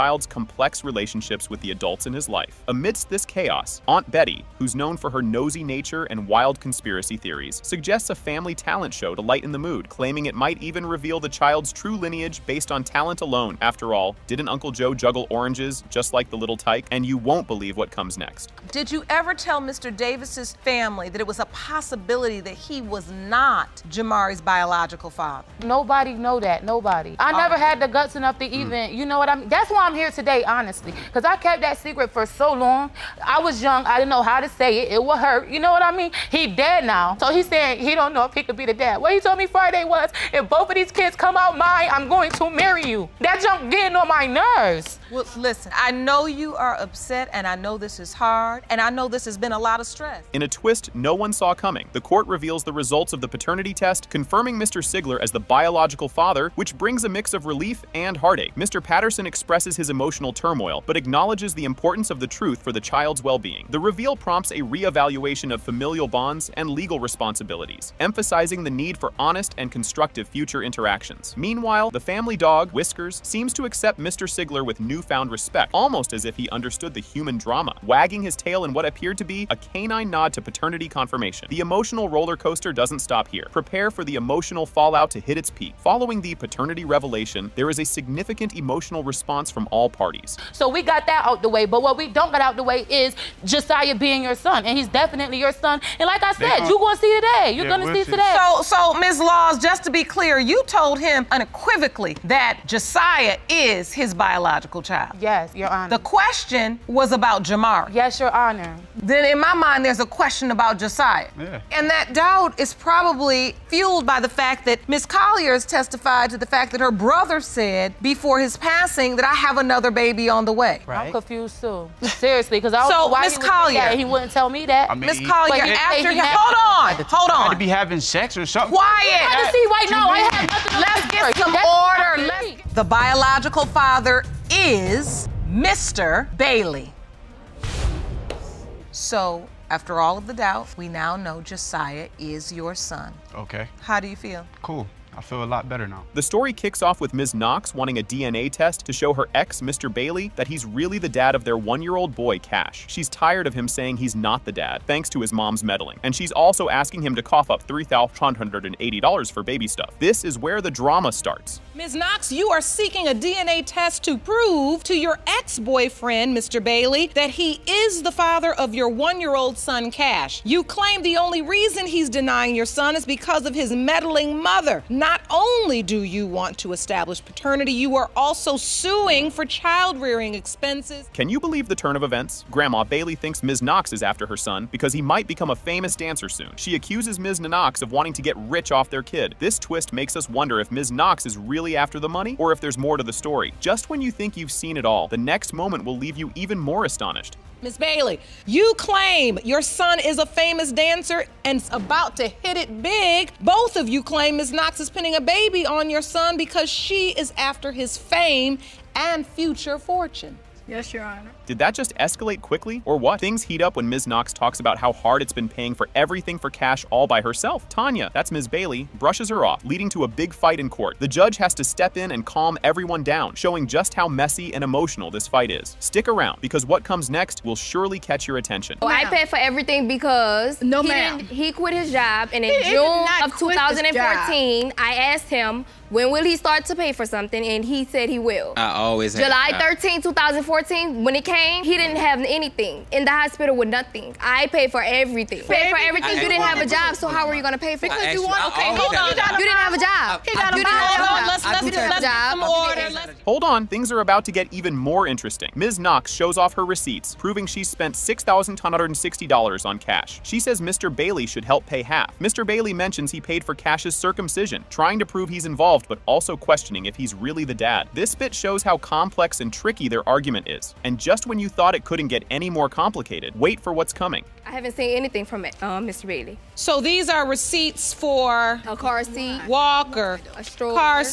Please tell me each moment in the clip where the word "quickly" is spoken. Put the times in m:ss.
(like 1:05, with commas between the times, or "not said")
3:32.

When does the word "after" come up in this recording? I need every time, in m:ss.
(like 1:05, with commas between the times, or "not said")
0:13, 2:05, 2:19, 3:04, 3:11, 3:27.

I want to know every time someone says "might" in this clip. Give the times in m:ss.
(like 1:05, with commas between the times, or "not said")
0:10, 3:04.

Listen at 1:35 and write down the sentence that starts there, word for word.
And like I said, you're gonna see today.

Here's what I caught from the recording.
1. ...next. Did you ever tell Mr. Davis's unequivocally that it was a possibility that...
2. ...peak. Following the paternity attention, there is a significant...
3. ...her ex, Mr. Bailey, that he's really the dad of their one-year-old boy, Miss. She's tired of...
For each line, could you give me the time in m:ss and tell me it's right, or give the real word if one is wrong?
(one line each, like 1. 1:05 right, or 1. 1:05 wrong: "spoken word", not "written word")
1. 0:18 wrong: "family", not "unequivocally"
2. 1:25 wrong: "revelation", not "attention"
3. 2:29 wrong: "Cash", not "Miss".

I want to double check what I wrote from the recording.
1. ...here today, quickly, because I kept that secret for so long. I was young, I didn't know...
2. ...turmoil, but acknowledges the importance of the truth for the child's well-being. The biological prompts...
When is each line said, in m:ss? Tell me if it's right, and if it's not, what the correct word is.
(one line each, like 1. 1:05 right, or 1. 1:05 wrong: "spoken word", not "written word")
1. 0:29 wrong: "honestly", not "quickly"
2. 1:00 wrong: "reveal", not "biological".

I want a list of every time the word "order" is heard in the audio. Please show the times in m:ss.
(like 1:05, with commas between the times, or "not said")
2:11, 4:12.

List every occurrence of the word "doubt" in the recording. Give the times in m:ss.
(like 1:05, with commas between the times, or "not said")
1:52, 2:20.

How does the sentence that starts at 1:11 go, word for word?
Meanwhile, the family dog, Whiskers, seems to accept Mr.